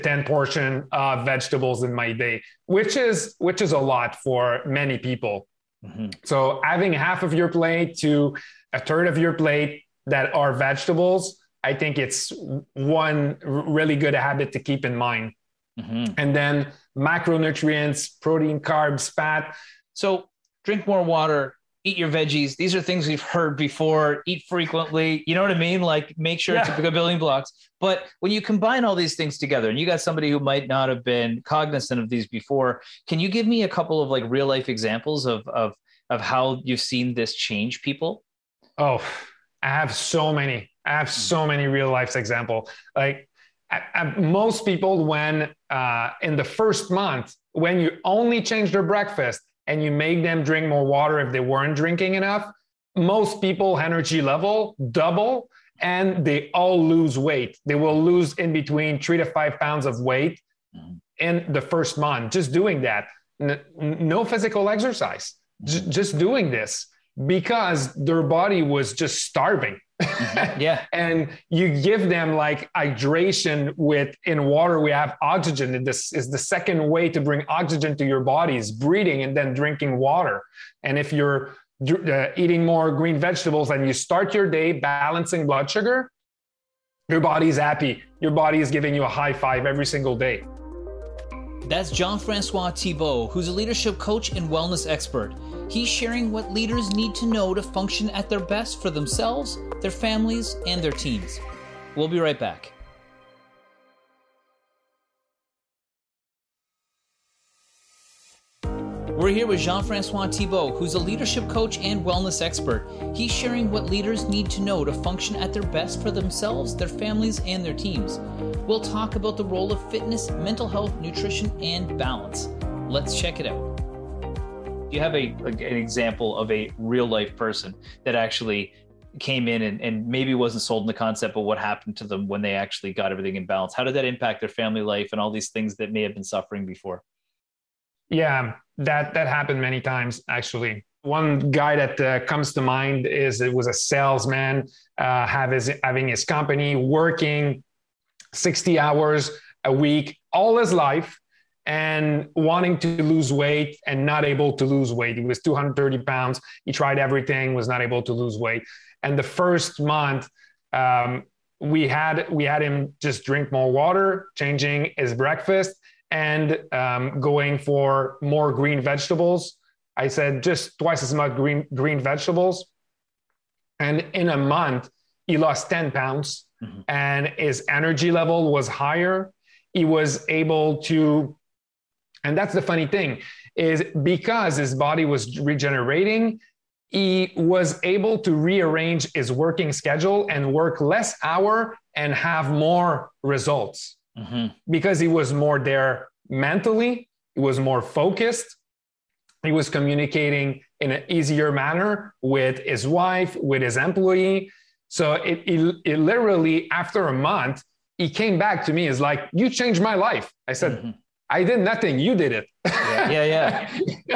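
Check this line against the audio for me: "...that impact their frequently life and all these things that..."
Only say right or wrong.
wrong.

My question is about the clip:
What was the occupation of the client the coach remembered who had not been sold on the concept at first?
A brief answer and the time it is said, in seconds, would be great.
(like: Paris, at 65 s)
Salesman, at 143 s.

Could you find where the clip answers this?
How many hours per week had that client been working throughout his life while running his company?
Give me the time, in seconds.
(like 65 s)
148 s.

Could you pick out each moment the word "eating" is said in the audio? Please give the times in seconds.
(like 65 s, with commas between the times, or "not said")
82 s.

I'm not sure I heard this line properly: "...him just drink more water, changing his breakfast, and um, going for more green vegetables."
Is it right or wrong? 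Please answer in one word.
right.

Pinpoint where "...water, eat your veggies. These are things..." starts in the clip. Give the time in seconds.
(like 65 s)
21 s.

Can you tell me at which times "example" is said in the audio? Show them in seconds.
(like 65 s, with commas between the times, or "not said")
34 s, 42 s, 125 s.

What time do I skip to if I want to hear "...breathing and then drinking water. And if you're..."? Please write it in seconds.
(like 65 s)
78 s.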